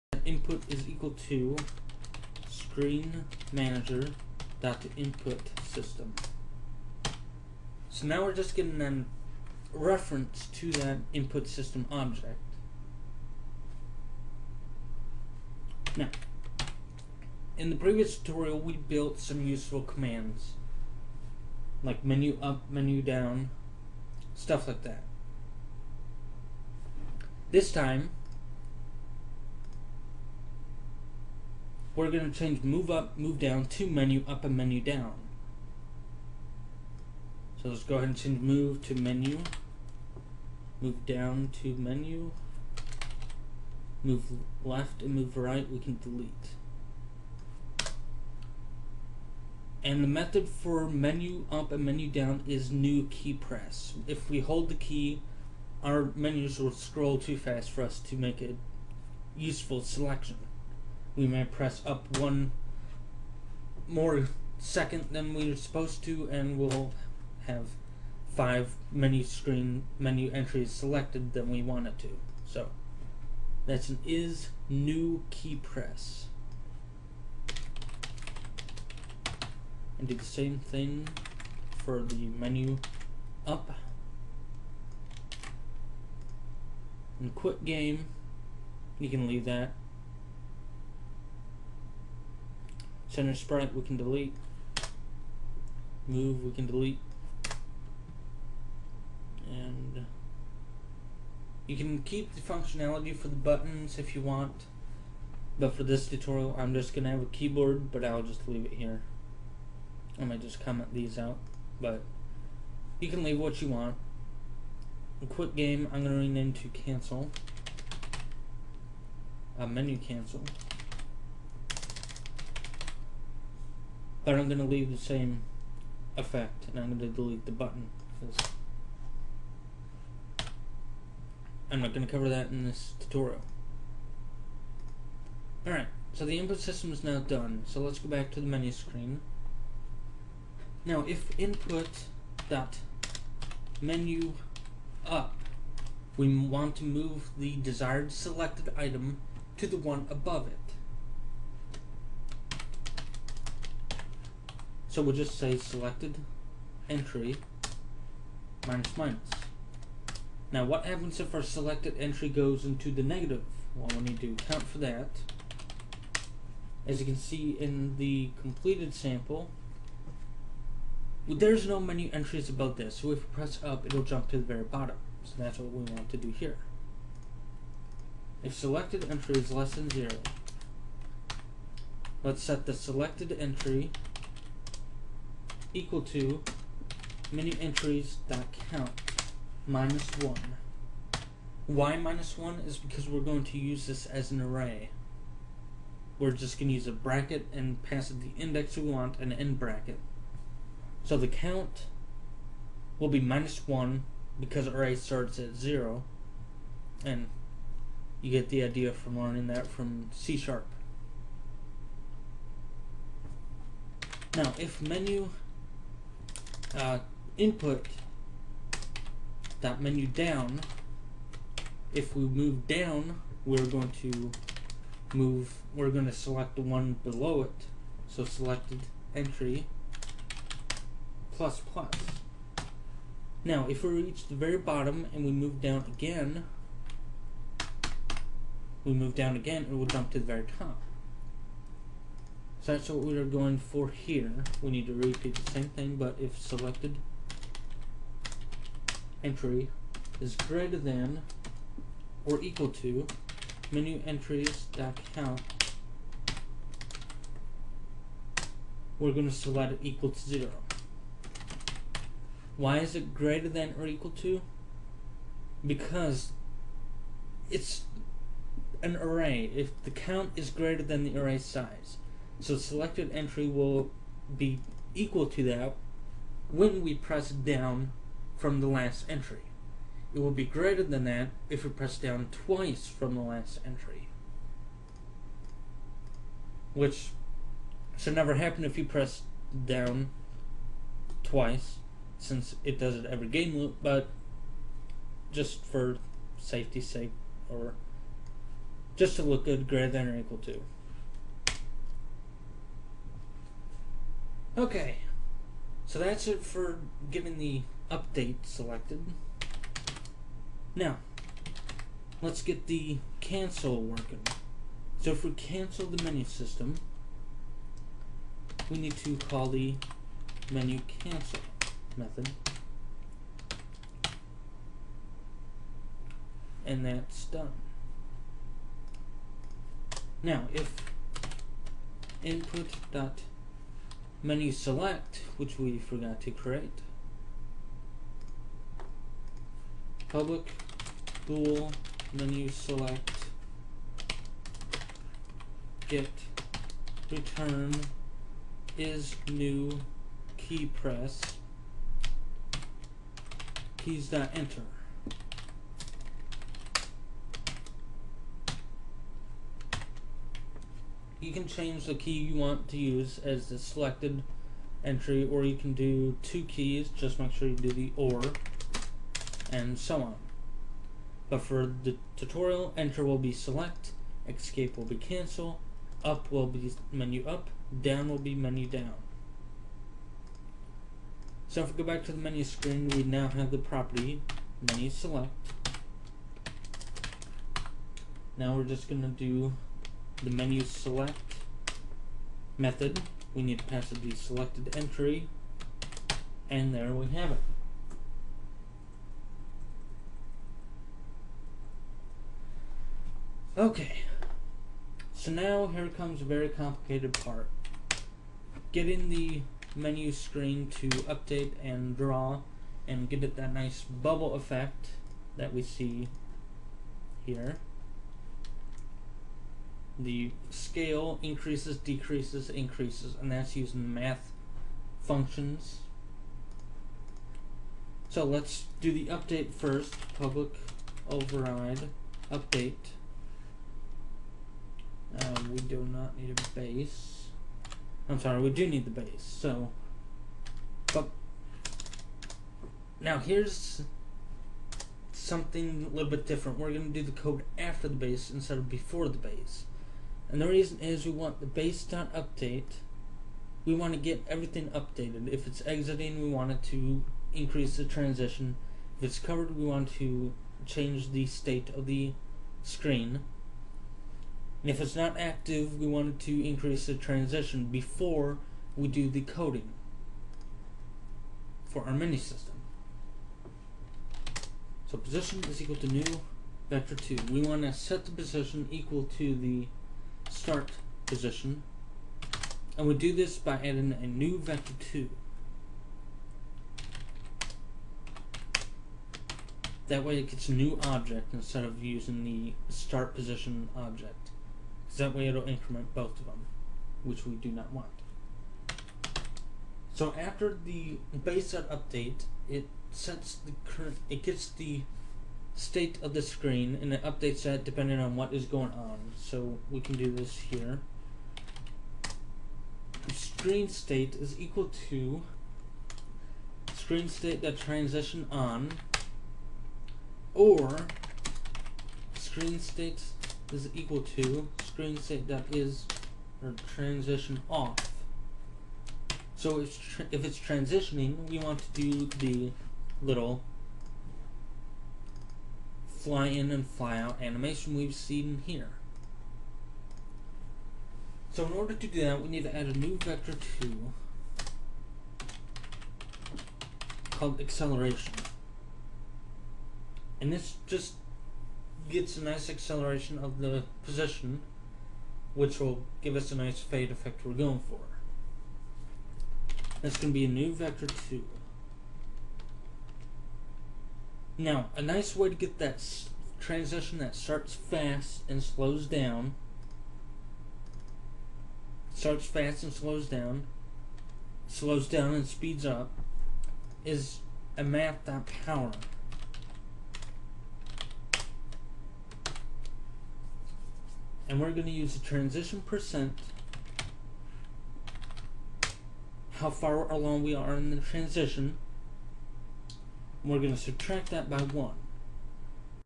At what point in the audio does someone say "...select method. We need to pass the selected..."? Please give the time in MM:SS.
06:30.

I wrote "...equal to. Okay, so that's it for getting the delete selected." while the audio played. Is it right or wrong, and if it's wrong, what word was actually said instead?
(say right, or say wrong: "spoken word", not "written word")
wrong: "update", not "delete".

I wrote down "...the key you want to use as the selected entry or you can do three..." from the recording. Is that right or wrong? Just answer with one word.
wrong.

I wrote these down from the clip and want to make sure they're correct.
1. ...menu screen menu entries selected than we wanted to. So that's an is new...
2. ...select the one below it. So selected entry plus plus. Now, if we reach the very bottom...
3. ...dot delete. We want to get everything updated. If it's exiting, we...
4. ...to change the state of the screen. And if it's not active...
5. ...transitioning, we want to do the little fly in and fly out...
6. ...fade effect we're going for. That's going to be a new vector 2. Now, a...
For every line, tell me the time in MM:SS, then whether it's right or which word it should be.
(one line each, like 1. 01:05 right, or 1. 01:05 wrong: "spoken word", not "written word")
1. 01:08 right
2. 03:46 right
3. 07:31 wrong: "update", not "delete"
4. 07:39 right
5. 08:50 right
6. 09:16 right.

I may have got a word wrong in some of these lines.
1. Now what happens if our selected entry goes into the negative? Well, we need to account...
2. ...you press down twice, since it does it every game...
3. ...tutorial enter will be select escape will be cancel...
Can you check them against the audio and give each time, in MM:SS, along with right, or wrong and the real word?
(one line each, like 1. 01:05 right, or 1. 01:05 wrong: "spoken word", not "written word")
1. 02:40 right
2. 04:48 right
3. 06:12 right.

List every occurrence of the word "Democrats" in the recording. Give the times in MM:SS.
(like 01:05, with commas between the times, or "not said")
not said.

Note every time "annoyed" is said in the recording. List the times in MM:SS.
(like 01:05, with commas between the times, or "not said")
not said.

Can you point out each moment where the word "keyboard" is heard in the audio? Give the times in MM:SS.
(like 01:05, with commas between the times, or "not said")
01:47.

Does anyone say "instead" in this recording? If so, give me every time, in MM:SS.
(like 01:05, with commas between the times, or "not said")
07:28, 08:11.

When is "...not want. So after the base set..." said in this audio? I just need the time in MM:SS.
08:17.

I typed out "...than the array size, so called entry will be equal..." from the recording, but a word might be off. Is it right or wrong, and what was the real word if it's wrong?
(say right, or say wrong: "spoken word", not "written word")
wrong: "selected", not "called".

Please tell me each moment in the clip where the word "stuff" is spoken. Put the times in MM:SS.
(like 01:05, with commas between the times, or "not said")
00:24.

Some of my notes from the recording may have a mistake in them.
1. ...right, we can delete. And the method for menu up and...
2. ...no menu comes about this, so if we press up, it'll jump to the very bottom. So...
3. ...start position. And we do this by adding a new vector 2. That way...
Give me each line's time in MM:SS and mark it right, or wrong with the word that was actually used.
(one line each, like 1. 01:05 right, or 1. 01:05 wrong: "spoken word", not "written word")
1. 00:45 right
2. 02:51 wrong: "entries", not "comes"
3. 08:00 right.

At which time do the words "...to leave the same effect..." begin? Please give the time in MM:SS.
02:04.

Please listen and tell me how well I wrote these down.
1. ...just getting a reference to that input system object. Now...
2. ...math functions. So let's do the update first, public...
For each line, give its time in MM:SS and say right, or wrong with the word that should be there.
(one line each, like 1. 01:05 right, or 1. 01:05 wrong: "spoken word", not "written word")
1. 00:08 right
2. 07:03 right.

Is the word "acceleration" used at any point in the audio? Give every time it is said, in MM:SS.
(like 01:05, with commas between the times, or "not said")
09:07, 09:12.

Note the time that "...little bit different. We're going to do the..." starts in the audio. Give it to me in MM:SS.
07:25.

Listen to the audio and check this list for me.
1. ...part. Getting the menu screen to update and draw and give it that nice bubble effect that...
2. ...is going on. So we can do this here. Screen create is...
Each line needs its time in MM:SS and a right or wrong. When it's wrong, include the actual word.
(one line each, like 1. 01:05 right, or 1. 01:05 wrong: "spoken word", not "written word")
1. 06:47 right
2. 08:28 wrong: "state", not "create".